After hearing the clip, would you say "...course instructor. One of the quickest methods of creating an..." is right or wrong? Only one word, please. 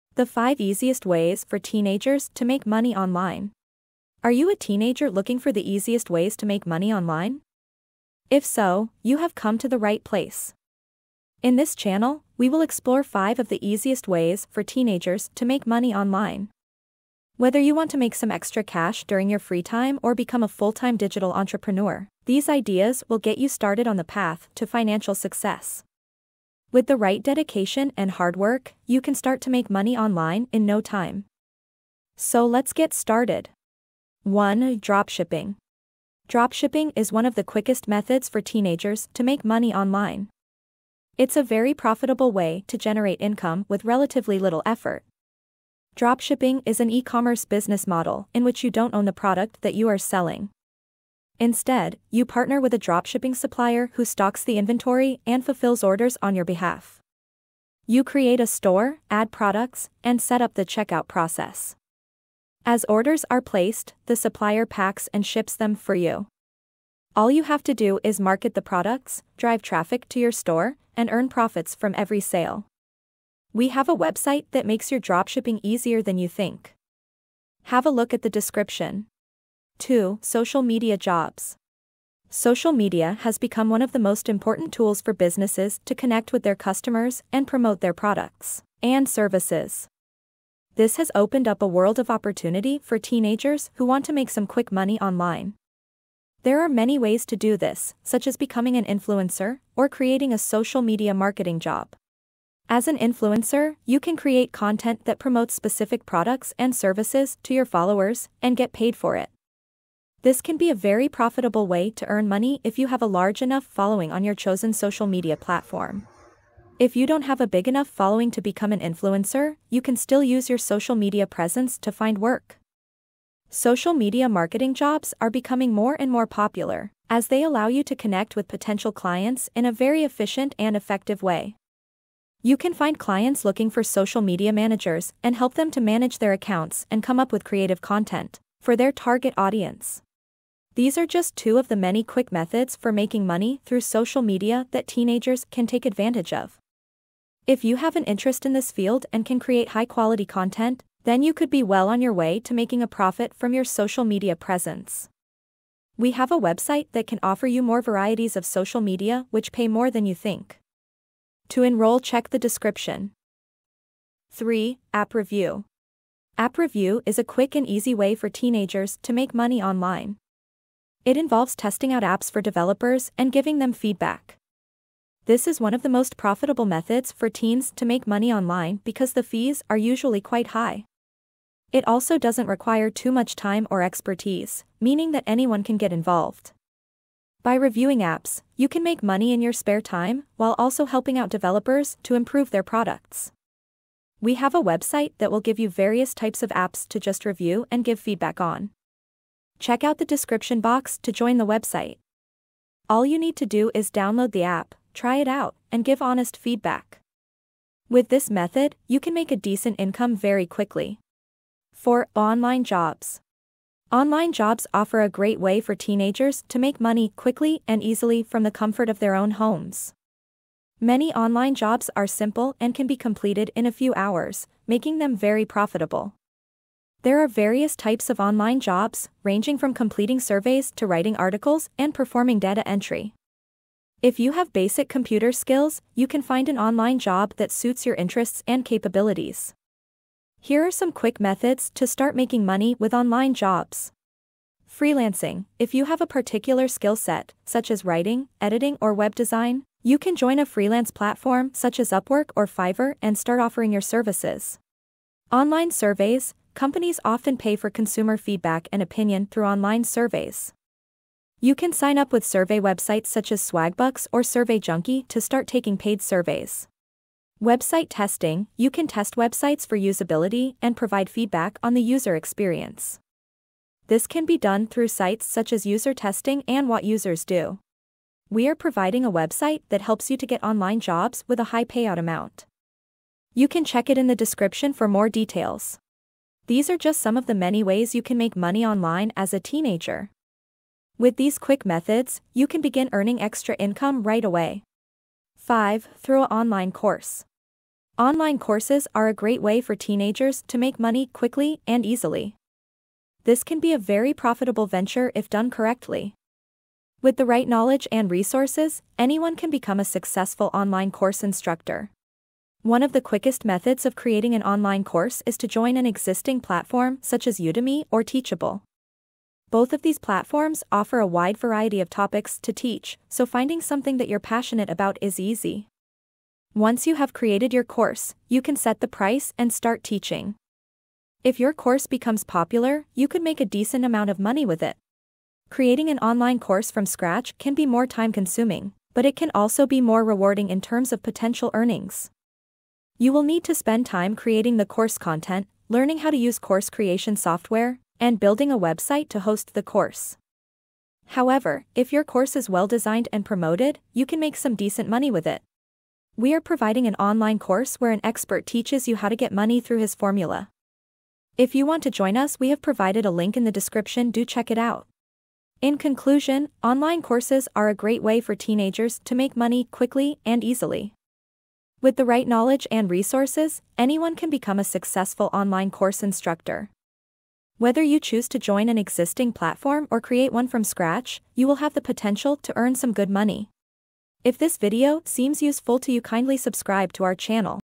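right.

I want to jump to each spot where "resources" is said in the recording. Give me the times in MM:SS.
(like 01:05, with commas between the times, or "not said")
05:08, 06:12.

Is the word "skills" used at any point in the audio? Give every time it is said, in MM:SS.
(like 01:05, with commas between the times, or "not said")
03:55, 04:06.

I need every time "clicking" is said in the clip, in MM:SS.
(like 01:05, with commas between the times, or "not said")
not said.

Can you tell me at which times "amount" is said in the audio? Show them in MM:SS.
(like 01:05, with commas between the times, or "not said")
04:41, 05:33.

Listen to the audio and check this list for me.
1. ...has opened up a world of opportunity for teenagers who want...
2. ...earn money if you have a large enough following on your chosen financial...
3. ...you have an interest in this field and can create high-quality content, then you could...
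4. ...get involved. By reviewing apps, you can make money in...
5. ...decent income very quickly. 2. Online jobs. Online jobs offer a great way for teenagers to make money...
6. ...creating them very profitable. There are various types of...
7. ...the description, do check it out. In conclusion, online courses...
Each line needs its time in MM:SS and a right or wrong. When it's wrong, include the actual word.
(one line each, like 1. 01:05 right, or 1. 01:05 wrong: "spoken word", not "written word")
1. 01:30 right
2. 01:52 wrong: "social", not "financial"
3. 02:27 right
4. 03:05 right
5. 03:29 wrong: "4", not "2"
6. 03:44 wrong: "making", not "creating"
7. 06:03 right.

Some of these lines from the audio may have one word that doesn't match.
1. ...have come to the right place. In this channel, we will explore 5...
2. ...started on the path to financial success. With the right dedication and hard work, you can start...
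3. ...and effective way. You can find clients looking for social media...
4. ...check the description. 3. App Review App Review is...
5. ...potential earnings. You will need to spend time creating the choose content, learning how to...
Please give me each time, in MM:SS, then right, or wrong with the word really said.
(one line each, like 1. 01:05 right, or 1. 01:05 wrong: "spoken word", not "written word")
1. 00:09 right
2. 00:23 right
3. 02:10 right
4. 02:41 right
5. 05:41 wrong: "course", not "choose".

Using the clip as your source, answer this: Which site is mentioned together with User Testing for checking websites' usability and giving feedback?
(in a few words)
What Users Do.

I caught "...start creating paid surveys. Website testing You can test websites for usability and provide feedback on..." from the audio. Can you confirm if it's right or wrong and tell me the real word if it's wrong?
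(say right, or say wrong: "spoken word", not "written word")
wrong: "taking", not "creating".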